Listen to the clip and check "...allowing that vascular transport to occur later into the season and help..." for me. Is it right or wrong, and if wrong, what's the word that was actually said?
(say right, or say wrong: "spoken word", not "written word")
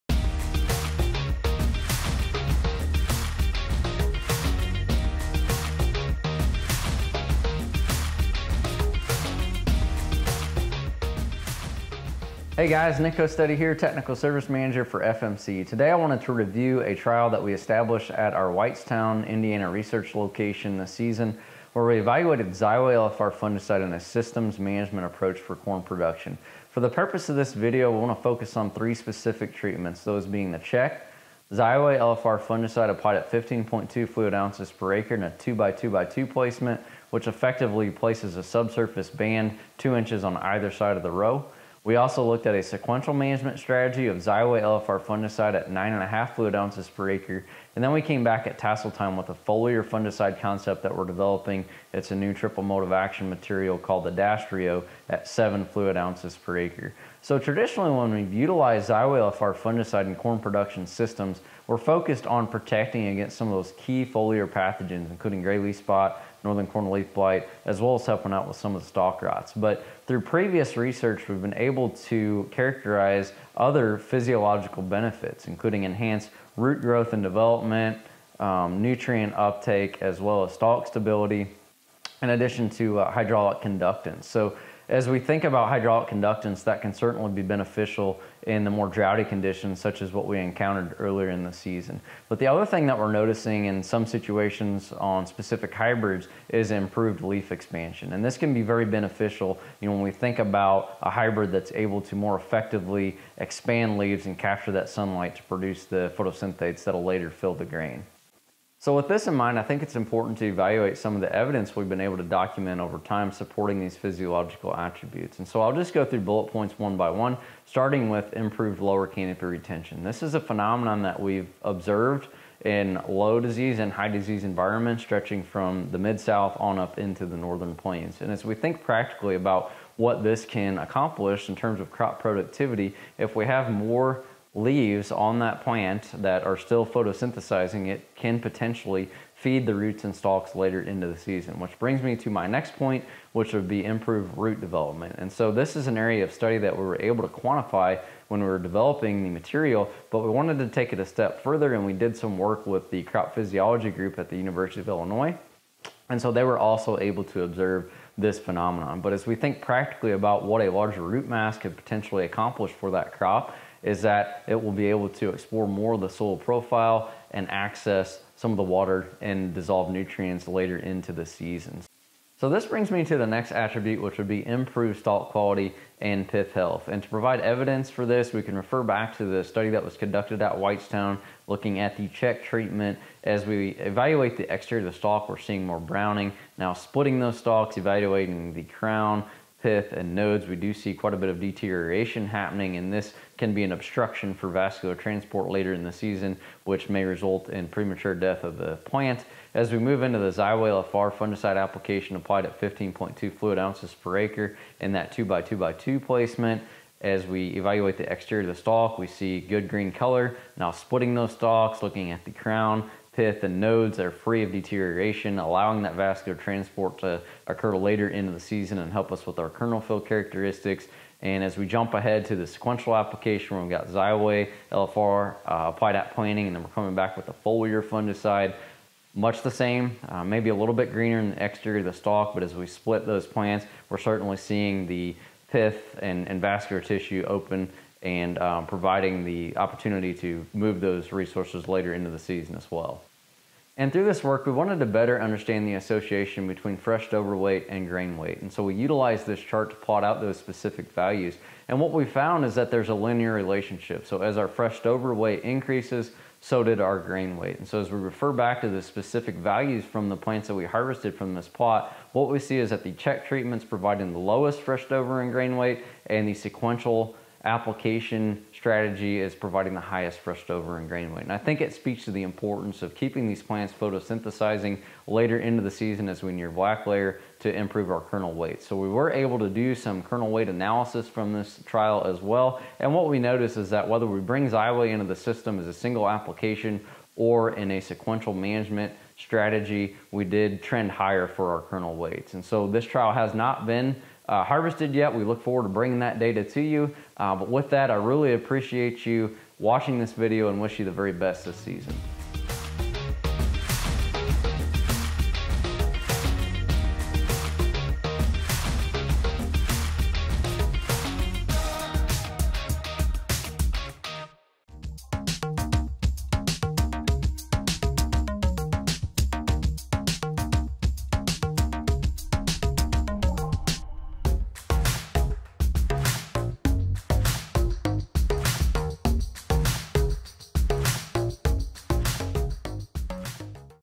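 right.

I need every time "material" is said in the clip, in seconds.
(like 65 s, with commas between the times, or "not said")
53 s, 149 s.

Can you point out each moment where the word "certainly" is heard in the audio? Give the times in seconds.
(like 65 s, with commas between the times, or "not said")
86 s, 233 s.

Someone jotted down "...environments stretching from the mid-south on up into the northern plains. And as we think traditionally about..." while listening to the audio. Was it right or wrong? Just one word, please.
wrong.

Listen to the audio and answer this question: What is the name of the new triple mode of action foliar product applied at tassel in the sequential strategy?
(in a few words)
Adastrio.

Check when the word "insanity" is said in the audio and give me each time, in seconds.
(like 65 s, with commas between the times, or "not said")
not said.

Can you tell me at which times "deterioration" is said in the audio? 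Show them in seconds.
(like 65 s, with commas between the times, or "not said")
191 s, 214 s.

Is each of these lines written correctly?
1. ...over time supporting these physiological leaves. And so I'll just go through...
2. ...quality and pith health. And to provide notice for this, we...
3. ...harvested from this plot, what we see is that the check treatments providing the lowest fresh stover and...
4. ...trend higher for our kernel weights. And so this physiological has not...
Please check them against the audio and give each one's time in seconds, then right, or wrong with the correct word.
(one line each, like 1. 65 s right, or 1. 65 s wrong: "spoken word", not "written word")
1. 112 s wrong: "attributes", not "leaves"
2. 175 s wrong: "evidence", not "notice"
3. 260 s right
4. 290 s wrong: "trial", not "physiological".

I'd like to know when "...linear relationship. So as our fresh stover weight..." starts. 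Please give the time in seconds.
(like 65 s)
252 s.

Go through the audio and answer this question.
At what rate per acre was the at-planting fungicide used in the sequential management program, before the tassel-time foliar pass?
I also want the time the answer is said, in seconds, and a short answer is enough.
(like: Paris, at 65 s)
9.5 fluid ounces per acre, at 45 s.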